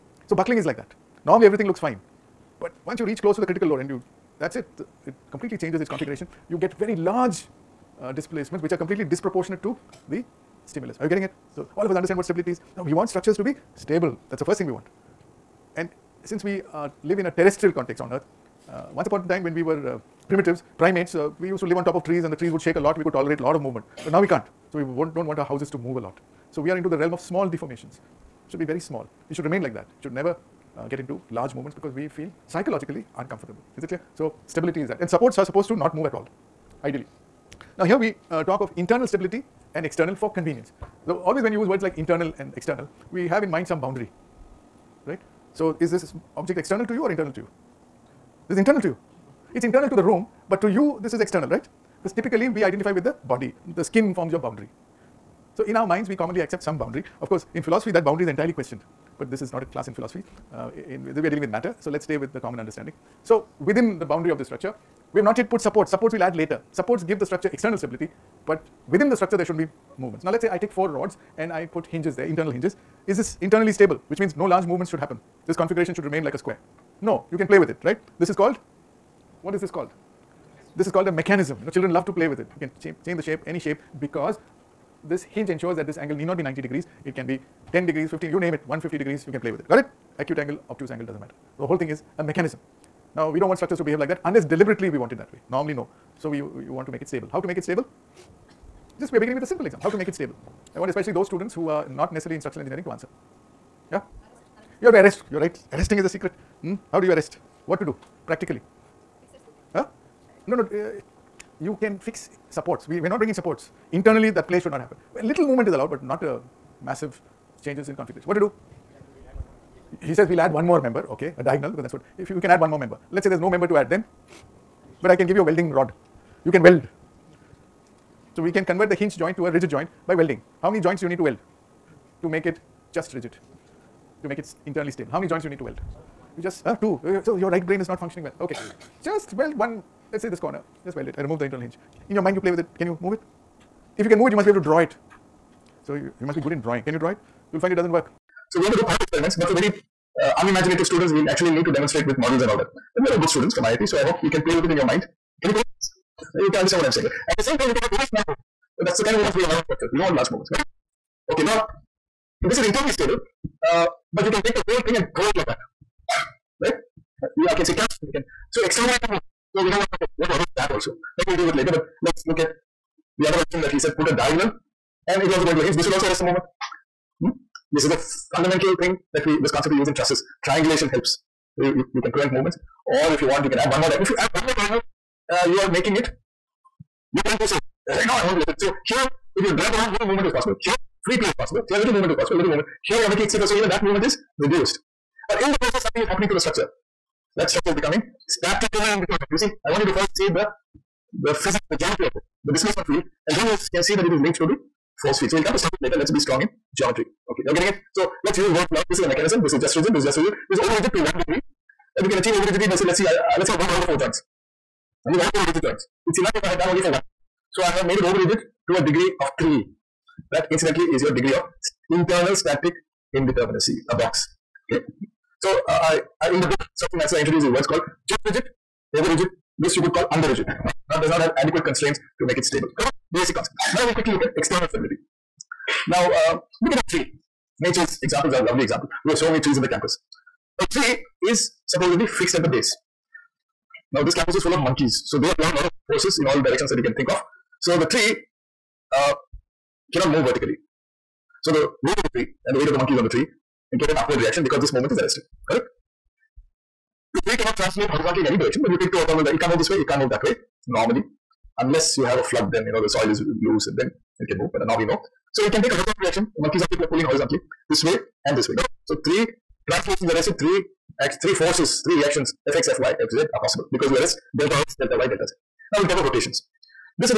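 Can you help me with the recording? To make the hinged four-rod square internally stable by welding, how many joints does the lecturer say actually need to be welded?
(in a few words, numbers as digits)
1.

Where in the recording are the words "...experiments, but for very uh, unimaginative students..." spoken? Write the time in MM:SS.
02:28.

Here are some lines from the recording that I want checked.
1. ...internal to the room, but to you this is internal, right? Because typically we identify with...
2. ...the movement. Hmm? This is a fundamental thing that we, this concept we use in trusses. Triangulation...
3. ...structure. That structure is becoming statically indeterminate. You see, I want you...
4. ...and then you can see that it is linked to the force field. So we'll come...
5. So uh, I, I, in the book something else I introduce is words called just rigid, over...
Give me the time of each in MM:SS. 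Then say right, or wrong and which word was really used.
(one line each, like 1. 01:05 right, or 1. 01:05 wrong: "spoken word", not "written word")
1. 00:49 wrong: "external", not "internal"
2. 02:56 right
3. 03:16 right
4. 03:23 right
5. 03:45 right.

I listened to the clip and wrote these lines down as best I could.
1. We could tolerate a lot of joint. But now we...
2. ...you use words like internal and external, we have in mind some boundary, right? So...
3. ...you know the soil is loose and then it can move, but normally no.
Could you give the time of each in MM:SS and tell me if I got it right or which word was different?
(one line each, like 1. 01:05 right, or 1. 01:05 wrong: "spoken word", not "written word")
1. 00:23 wrong: "movement", not "joint"
2. 00:41 right
3. 04:22 right.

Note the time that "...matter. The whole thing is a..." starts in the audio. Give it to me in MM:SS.
01:31.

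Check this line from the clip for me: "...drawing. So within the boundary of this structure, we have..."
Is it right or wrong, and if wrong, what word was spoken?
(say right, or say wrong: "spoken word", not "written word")
wrong: "understanding", not "drawing".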